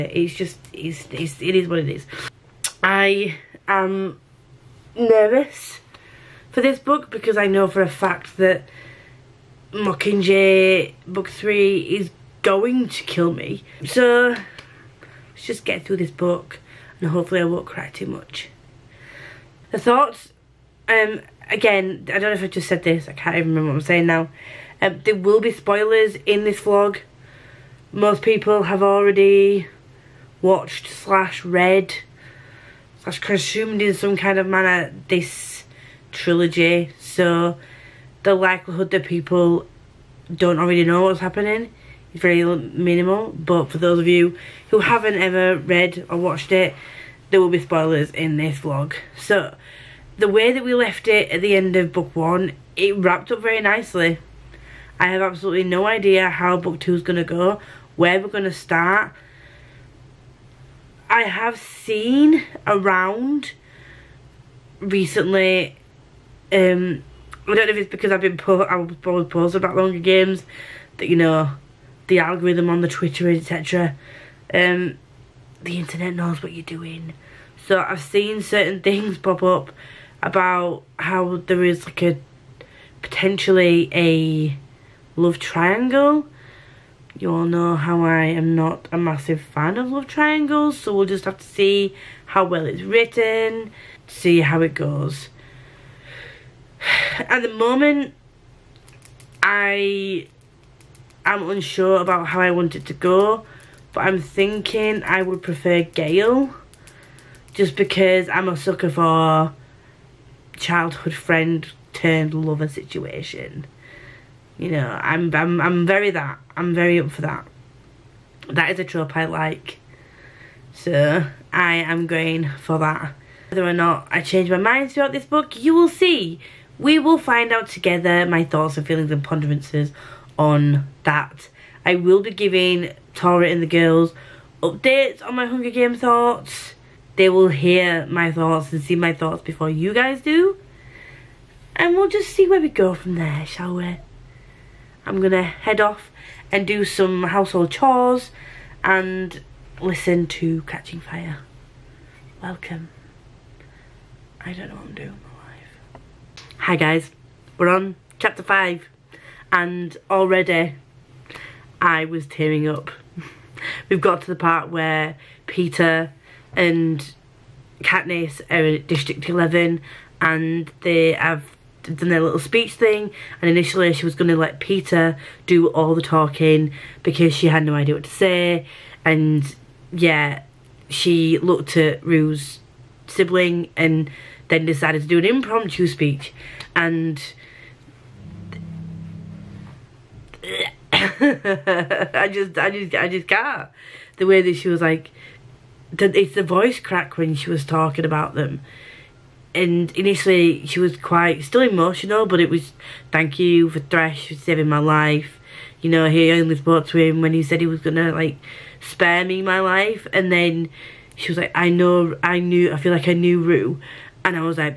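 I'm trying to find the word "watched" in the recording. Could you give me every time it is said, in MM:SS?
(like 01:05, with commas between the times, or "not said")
00:30, 00:46.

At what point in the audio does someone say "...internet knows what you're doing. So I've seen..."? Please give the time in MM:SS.
01:15.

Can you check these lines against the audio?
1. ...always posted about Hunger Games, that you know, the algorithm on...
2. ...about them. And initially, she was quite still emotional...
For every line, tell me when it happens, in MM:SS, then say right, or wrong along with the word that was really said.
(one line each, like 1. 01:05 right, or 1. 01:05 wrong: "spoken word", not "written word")
1. 01:09 right
2. 03:18 right.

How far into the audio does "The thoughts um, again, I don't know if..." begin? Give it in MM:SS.
00:19.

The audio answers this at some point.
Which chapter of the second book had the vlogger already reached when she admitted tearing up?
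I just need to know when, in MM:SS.
02:38.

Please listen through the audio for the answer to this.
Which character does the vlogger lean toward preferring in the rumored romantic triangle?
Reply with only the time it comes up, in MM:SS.
01:45.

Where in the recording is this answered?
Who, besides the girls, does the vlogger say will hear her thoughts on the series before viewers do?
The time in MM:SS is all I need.
02:13.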